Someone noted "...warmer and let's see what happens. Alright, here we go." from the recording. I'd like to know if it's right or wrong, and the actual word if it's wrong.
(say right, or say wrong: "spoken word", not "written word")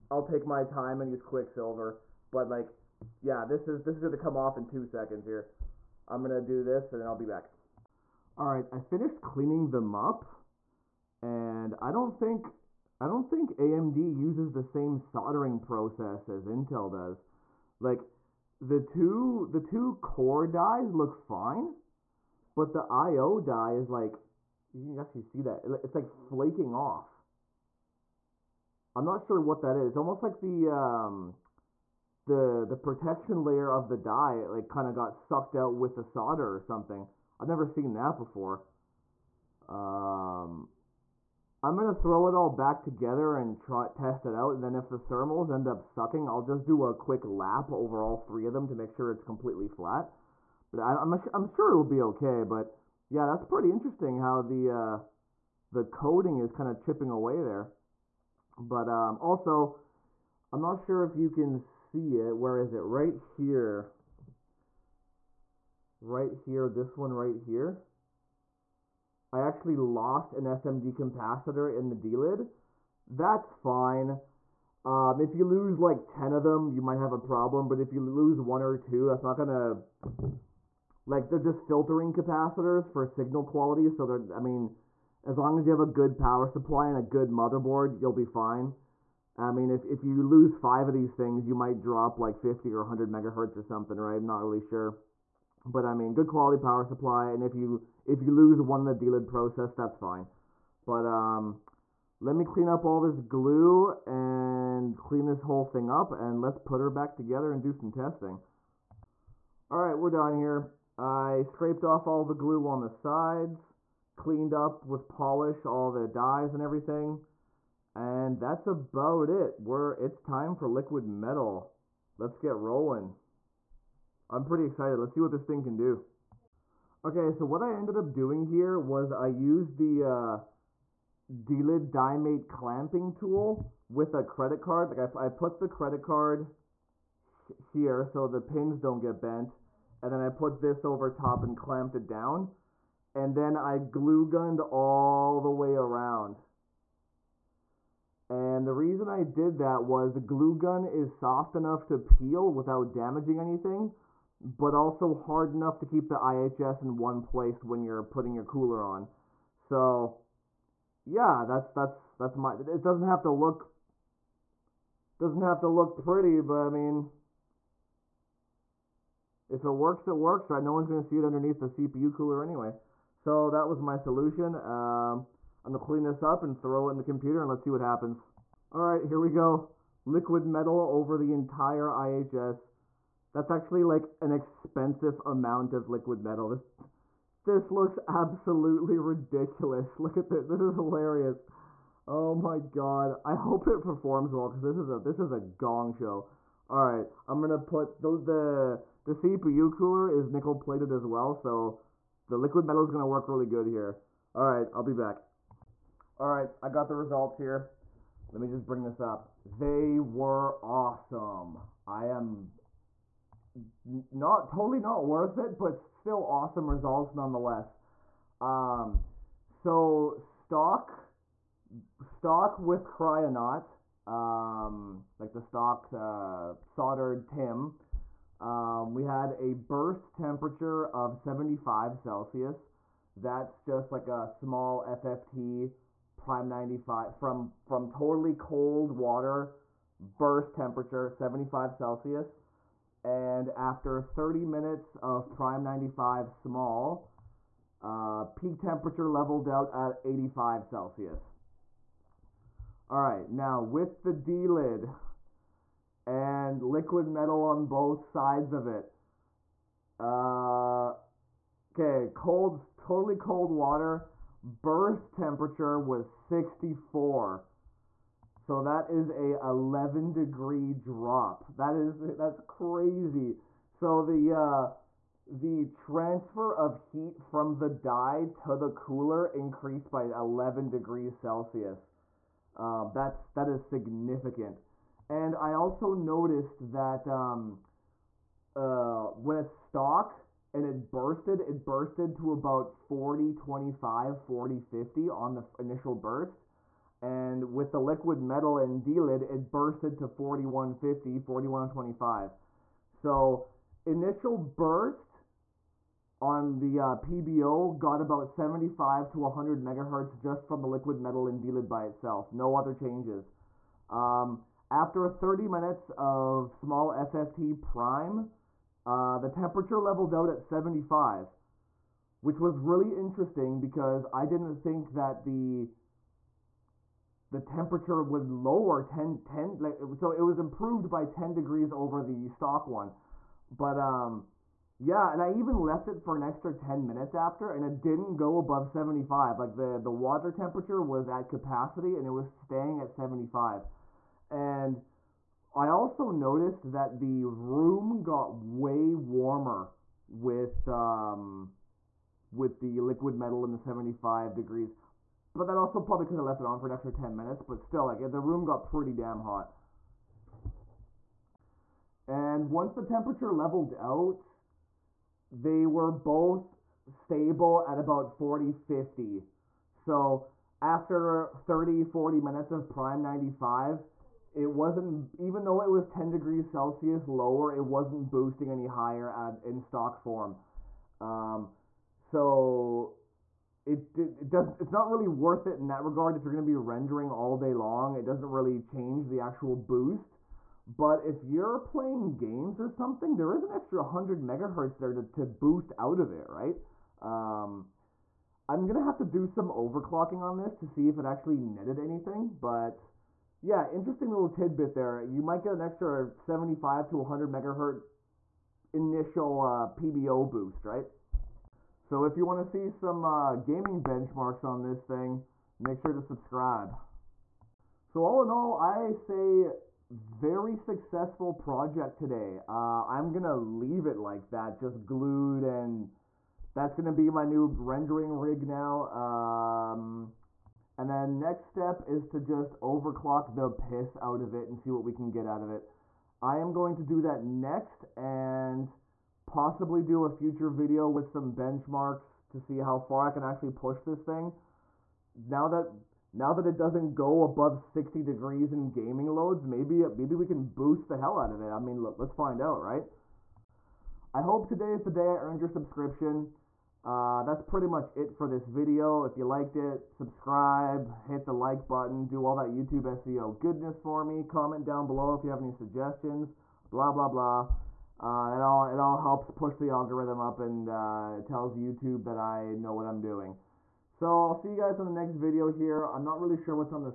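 wrong: "computer", not "warmer".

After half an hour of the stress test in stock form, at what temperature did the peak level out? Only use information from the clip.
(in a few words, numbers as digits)
85 Celsius.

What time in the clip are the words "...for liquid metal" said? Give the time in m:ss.
2:00.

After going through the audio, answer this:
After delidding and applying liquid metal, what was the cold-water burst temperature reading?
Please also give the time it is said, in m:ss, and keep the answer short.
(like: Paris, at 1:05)
64, at 4:26.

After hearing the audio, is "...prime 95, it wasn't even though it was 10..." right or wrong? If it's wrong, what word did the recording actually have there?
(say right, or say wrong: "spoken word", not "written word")
right.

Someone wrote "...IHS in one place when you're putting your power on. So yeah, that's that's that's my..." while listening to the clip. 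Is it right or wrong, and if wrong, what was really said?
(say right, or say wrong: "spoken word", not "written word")
wrong: "cooler", not "power".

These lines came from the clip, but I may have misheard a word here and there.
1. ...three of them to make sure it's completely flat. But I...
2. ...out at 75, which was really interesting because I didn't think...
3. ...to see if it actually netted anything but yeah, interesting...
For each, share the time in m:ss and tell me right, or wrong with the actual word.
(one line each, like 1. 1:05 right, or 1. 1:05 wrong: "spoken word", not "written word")
1. 0:48 right
2. 5:20 right
3. 6:40 right.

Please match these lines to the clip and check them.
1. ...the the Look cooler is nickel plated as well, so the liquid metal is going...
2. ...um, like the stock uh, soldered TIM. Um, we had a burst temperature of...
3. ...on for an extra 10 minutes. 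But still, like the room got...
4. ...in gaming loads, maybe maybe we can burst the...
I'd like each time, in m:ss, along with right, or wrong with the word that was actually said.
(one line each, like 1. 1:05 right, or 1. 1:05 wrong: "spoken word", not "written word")
1. 3:18 wrong: "CPU", not "Look"
2. 3:44 right
3. 5:56 right
4. 7:28 wrong: "boost", not "burst".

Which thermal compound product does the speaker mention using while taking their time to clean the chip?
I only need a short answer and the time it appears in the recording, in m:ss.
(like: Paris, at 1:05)
Quicksilver, at 0:01.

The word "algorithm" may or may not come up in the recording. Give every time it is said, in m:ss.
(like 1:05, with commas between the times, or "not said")
7:49.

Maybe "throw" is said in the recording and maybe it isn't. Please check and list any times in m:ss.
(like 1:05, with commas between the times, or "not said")
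0:41, 2:56.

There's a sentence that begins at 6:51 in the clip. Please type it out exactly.
So if you want to see some uh, gaming benchmarks on this thing, make sure to subscribe.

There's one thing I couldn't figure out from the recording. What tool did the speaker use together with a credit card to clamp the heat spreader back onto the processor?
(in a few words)
Delid Die Mate.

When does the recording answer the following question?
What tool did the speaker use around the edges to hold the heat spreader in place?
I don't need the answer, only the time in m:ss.
2:30.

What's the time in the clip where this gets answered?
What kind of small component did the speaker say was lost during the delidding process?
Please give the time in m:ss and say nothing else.
1:10.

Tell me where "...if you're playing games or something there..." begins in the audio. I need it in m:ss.
6:31.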